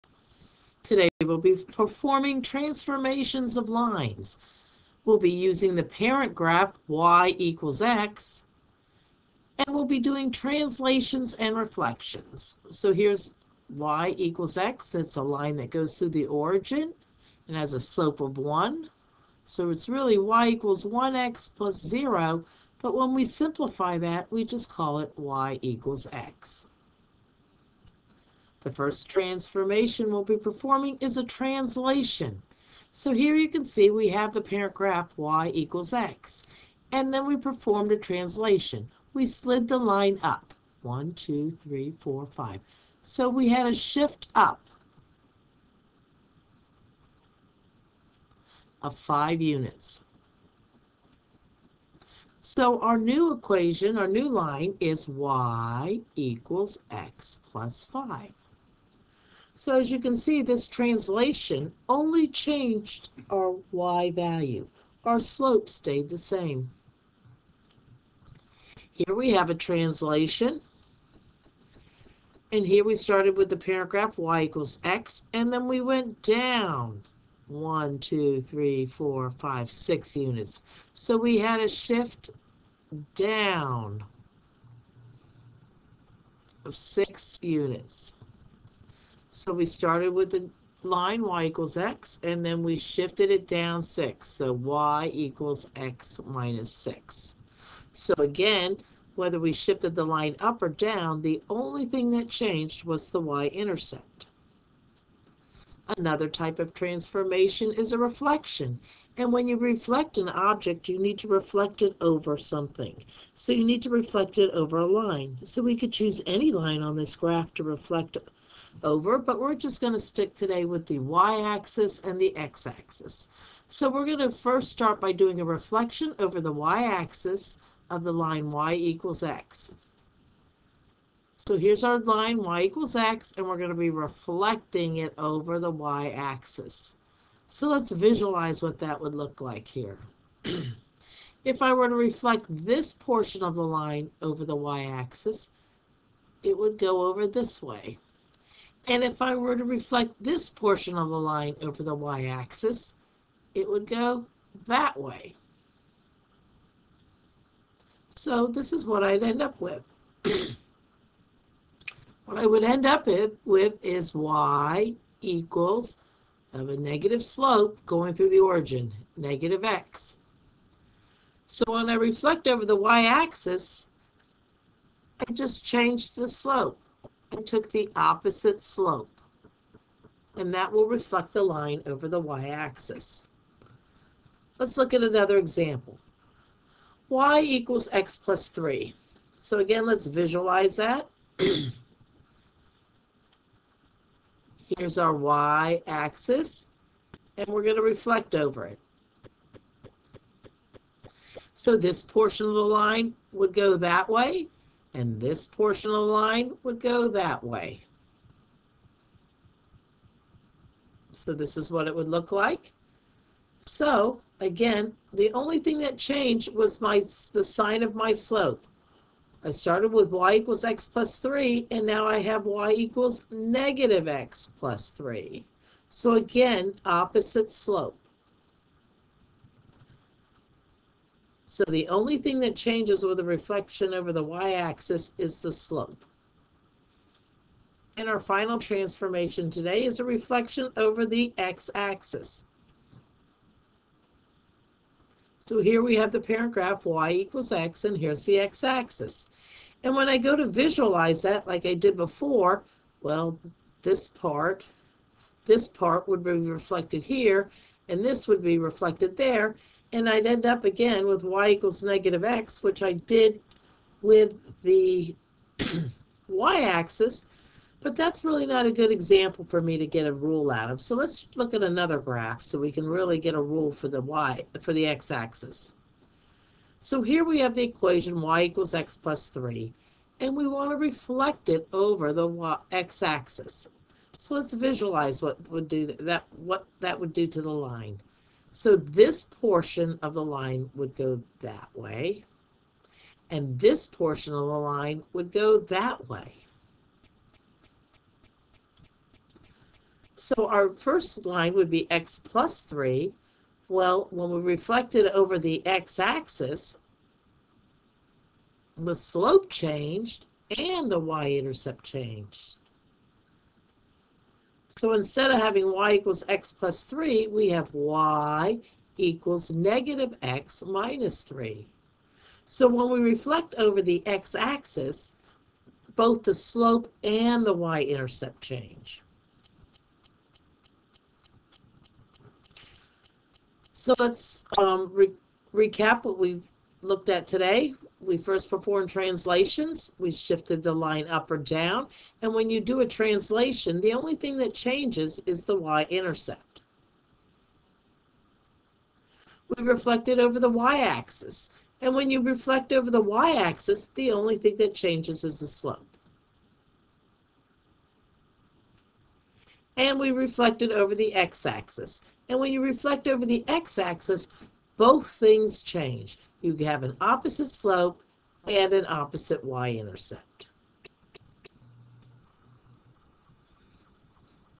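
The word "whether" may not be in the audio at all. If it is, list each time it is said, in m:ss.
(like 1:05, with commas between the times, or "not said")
1:39.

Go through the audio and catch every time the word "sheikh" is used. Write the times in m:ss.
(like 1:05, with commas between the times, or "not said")
not said.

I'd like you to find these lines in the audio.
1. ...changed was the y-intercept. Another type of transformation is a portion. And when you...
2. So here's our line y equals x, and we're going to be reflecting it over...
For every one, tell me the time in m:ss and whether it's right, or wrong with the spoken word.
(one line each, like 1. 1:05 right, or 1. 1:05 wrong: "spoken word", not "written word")
1. 1:42 wrong: "reflection", not "portion"
2. 2:11 right.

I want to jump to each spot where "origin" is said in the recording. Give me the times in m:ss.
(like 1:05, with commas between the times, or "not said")
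0:16, 2:48.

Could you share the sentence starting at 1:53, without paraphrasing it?
So you need to reflect it over a line.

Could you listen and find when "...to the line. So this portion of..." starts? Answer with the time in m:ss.
4:47.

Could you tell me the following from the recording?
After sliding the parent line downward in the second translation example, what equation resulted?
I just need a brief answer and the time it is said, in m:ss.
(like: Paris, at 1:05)
y = x - 6, at 1:34.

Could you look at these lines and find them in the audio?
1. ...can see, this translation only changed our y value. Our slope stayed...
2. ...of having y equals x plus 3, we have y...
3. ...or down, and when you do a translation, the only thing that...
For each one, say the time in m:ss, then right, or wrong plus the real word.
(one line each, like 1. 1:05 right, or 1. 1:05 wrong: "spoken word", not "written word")
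1. 0:59 right
2. 5:15 right
3. 5:41 right.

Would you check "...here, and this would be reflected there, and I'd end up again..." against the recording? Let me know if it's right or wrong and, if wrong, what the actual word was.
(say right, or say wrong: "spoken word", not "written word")
right.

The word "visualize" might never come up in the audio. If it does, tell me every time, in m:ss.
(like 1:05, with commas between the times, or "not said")
2:17, 3:10, 4:10, 4:44.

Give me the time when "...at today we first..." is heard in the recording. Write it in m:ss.
5:37.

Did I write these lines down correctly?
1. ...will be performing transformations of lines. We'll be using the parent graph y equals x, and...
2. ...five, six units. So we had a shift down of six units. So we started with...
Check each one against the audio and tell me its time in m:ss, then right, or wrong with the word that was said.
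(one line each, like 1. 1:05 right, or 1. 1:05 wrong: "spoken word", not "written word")
1. 0:01 right
2. 1:19 right.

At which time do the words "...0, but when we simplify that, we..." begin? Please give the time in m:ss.
0:21.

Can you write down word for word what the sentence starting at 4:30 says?
So let's look at another graph so we can really get a rule for the y, for the x-axis.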